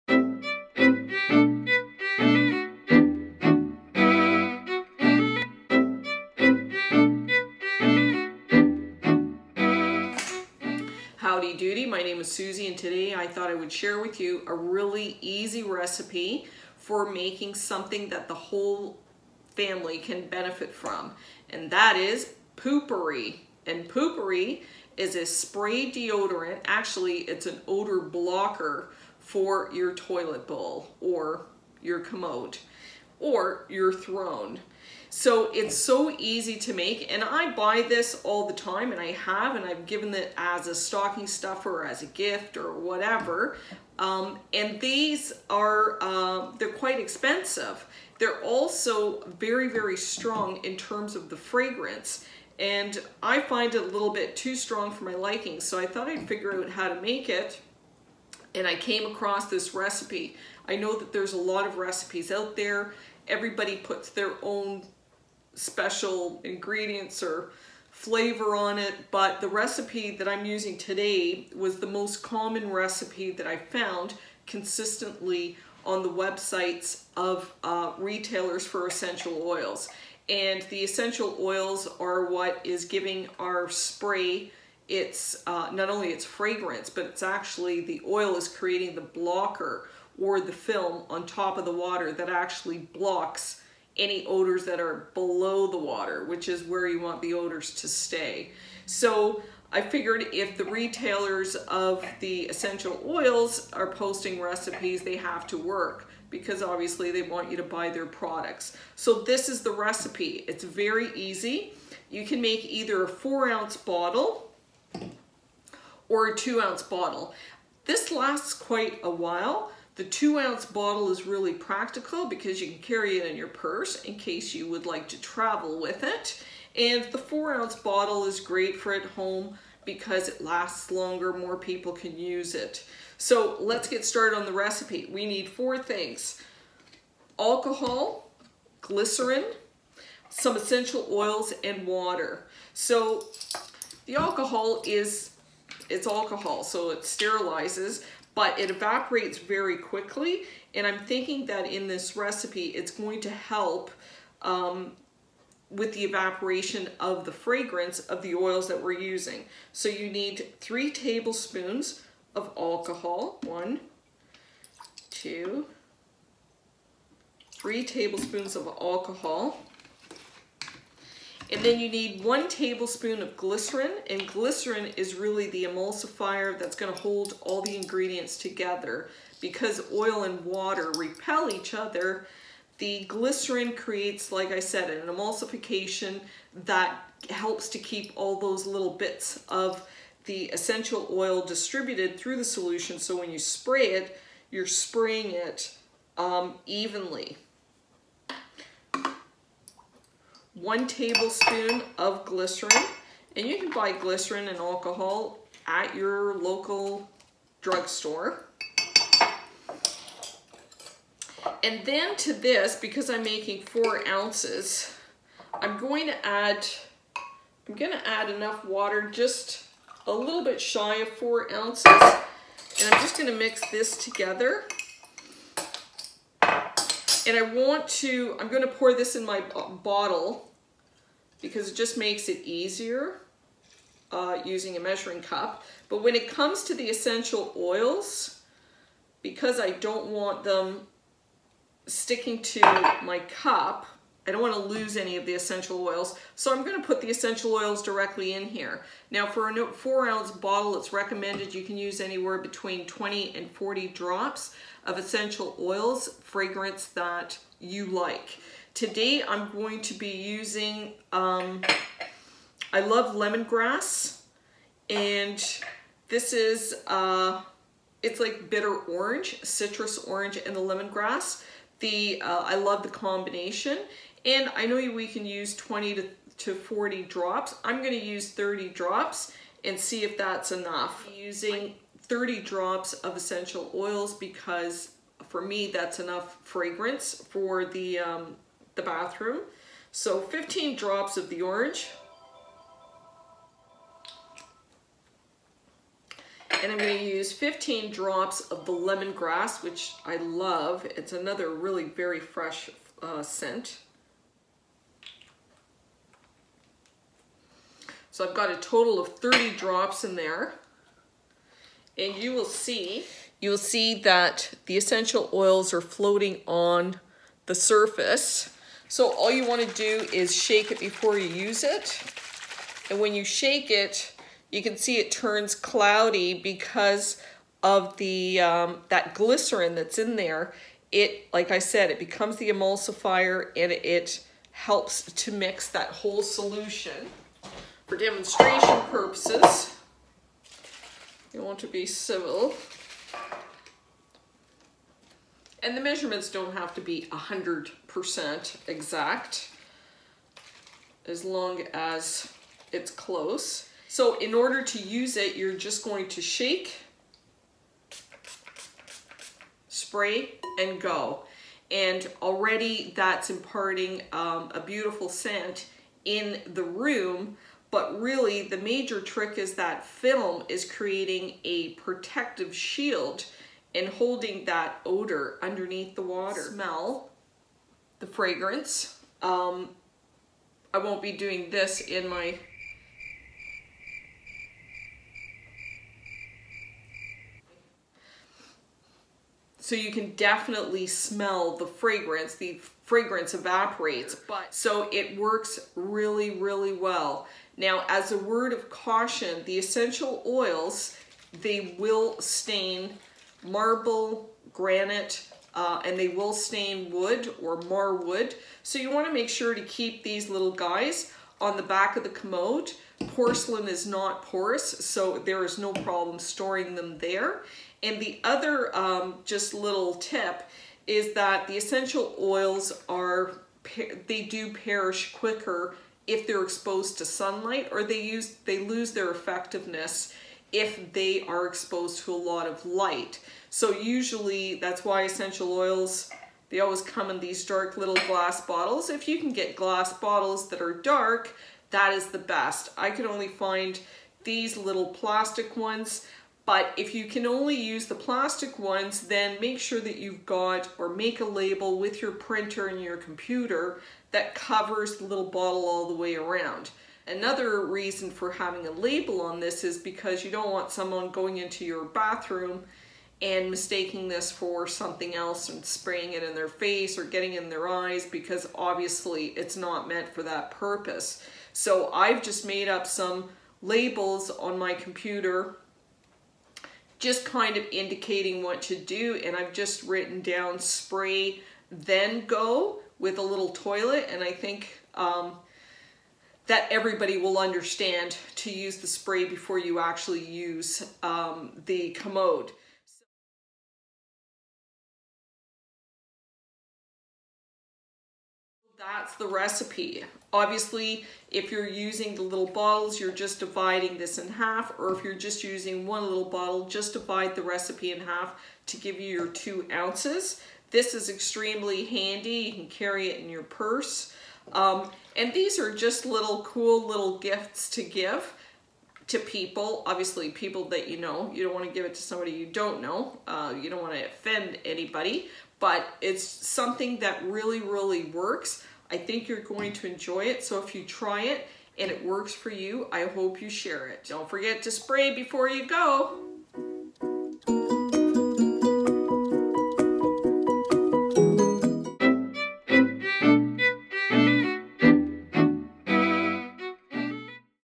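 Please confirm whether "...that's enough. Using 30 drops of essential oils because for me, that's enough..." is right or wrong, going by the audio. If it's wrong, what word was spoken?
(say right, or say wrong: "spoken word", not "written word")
right.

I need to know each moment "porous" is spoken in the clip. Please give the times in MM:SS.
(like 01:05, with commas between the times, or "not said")
06:54.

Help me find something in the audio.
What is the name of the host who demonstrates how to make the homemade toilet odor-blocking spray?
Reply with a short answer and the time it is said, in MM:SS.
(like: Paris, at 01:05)
Susie, at 00:12.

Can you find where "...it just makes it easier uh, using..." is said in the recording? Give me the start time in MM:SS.
03:51.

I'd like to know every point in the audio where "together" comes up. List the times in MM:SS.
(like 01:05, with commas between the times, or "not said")
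02:58, 03:44.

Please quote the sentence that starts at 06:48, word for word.
So you wanna make sure to keep these little guys on the back of the commode.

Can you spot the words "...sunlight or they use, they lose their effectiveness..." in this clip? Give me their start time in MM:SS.
07:07.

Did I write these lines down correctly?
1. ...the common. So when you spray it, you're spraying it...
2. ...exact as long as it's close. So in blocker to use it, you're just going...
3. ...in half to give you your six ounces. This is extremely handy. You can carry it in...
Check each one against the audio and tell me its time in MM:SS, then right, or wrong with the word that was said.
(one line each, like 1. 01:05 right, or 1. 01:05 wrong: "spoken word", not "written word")
1. 03:12 wrong: "solution", not "common"
2. 05:48 wrong: "order", not "blocker"
3. 08:27 wrong: "two", not "six".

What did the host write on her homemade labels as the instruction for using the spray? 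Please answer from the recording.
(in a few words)
Spray then go.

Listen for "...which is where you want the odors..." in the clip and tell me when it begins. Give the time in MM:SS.
01:36.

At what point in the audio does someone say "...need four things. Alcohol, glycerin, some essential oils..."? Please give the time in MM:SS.
02:15.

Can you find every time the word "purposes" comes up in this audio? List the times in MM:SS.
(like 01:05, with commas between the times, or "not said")
05:38, 07:50.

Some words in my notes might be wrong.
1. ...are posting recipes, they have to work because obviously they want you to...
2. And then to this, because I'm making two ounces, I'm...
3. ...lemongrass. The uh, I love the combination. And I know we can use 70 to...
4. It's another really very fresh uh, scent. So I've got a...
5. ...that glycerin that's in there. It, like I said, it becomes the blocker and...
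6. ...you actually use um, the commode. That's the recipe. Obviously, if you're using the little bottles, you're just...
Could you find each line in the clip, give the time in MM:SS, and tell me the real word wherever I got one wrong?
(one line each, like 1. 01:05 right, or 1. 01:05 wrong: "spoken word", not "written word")
1. 01:43 right
2. 03:31 wrong: "four", not "two"
3. 04:30 wrong: "20", not "70"
4. 05:00 right
5. 05:28 wrong: "emulsifier", not "blocker"
6. 08:09 right.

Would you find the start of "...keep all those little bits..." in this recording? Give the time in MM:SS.
03:07.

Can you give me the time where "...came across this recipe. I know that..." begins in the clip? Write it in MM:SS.
00:58.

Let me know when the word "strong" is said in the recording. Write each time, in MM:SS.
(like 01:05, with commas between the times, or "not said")
00:49, 00:54.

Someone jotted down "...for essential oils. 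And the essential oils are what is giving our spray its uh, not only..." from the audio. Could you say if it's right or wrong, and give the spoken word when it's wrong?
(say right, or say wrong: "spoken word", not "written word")
right.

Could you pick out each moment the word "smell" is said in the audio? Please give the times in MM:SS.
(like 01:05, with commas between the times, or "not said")
06:16, 06:30.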